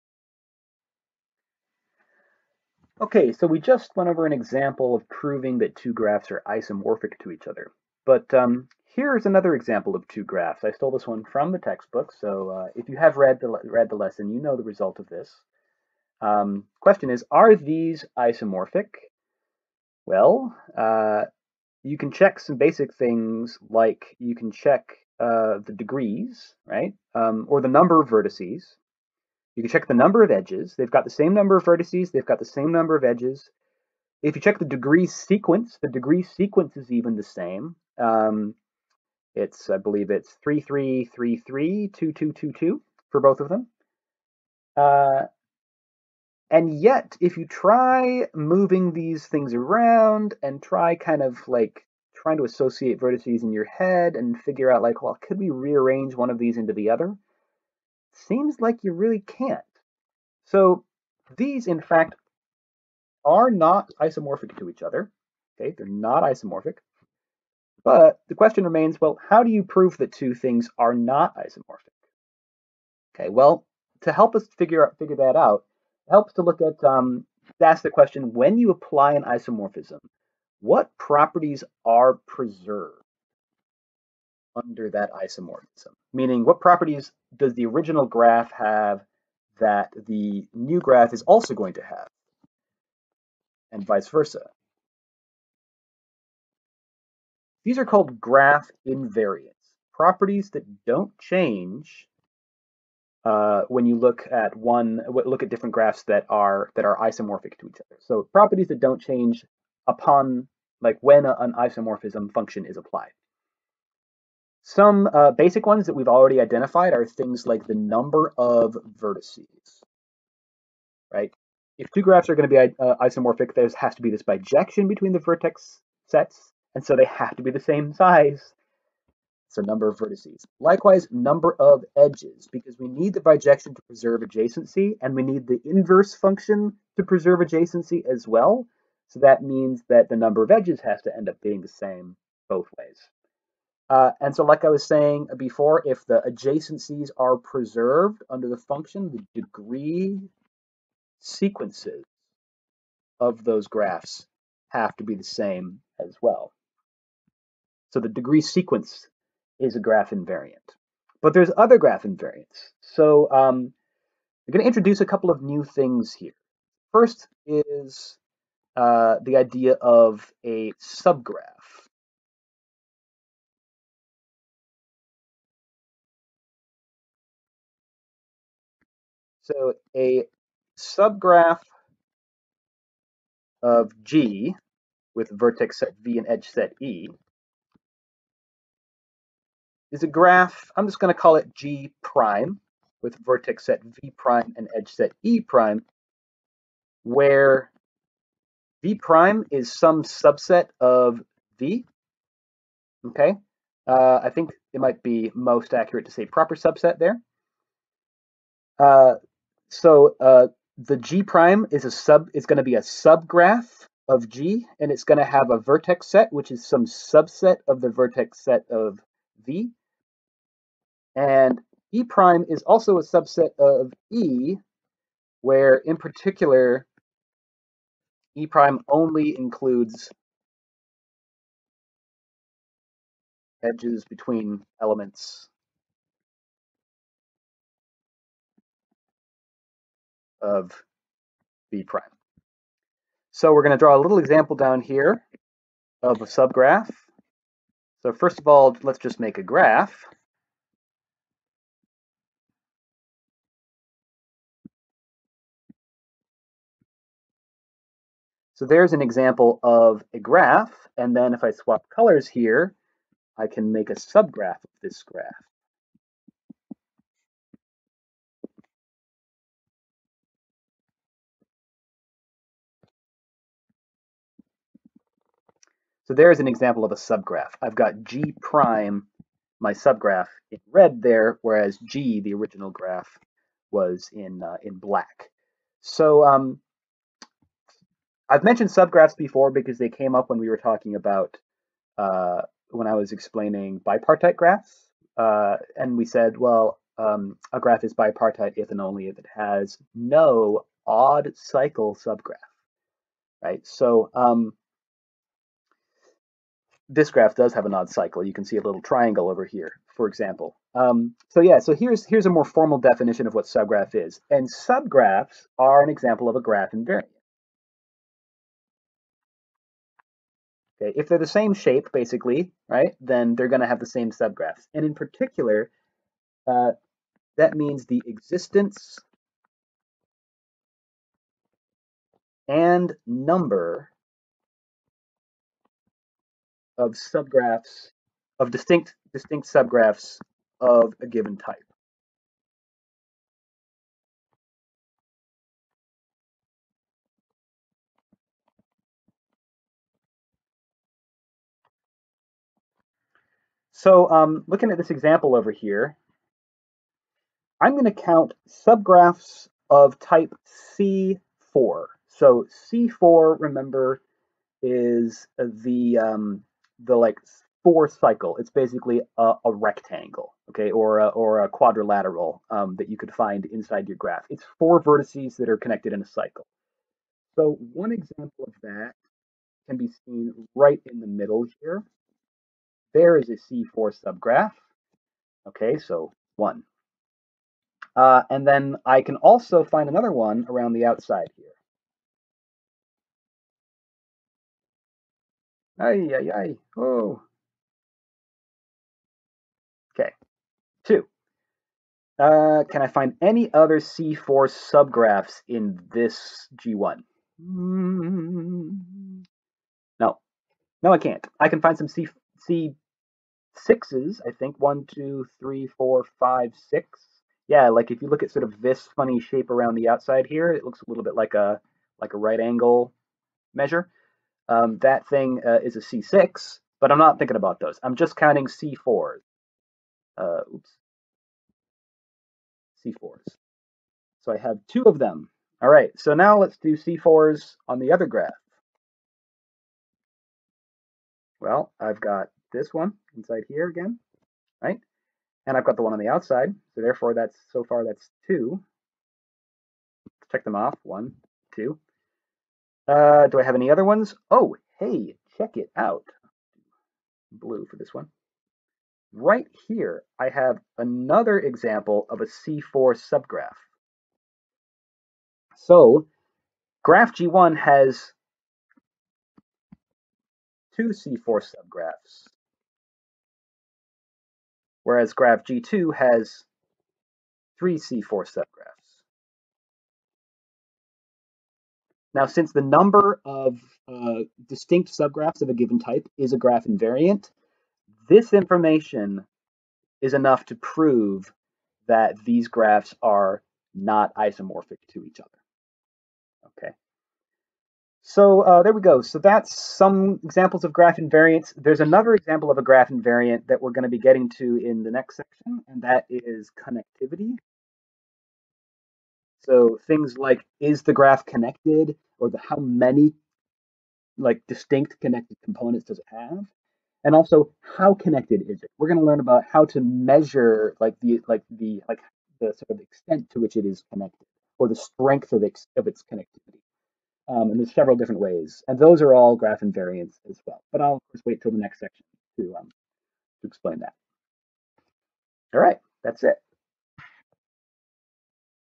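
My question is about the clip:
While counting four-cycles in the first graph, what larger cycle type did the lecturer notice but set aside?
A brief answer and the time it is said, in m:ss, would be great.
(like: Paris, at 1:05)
C6, at 7:05.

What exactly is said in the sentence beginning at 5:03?
So um, this graph does have an odd cycle.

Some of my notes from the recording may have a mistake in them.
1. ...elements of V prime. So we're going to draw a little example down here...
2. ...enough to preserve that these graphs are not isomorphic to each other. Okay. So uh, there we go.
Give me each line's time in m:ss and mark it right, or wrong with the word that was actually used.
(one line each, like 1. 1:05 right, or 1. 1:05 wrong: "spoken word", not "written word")
1. 3:54 right
2. 8:10 wrong: "prove", not "preserve".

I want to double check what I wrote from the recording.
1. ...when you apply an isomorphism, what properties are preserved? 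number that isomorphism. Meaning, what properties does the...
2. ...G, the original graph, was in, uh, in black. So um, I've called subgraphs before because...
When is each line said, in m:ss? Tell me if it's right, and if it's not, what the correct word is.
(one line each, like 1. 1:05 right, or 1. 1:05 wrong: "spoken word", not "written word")
1. 1:18 wrong: "under", not "number"
2. 4:41 wrong: "mentioned", not "called".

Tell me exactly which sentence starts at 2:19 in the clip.
So that means that the number of edges has to end up being the same both ways.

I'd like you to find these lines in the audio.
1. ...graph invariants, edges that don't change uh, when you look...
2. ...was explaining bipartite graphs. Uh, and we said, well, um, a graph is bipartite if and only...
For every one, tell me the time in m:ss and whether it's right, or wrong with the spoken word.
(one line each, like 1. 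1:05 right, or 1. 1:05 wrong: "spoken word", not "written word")
1. 1:38 wrong: "properties", not "edges"
2. 4:52 right.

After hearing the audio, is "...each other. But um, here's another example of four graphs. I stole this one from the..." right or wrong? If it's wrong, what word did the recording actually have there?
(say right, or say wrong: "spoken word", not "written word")
wrong: "two", not "four".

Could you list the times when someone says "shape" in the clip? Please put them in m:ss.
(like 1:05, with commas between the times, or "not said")
5:21, 6:59.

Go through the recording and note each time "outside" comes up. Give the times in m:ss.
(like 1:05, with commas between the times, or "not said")
6:30, 6:59, 7:26.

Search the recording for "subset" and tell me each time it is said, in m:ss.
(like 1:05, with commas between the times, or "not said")
3:20, 3:26, 3:36, 3:43.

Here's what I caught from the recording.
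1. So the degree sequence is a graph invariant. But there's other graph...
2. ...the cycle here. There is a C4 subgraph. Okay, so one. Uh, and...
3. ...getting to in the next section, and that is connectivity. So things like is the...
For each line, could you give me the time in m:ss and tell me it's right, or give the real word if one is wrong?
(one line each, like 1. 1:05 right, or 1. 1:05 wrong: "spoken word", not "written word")
1. 2:37 right
2. 6:20 wrong: "middle", not "cycle"
3. 8:23 right.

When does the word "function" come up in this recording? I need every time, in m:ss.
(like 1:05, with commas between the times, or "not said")
1:52, 2:16, 2:28.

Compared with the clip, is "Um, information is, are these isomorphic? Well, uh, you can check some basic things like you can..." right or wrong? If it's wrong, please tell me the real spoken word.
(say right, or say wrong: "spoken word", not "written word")
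wrong: "question", not "information".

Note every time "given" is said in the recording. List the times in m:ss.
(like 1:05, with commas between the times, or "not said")
5:41, 8:05.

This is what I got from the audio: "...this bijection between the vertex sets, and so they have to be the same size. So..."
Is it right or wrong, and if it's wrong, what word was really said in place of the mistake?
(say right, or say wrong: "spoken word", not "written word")
right.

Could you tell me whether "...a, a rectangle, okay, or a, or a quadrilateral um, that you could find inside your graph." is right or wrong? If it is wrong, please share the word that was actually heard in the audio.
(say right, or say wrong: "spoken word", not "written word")
right.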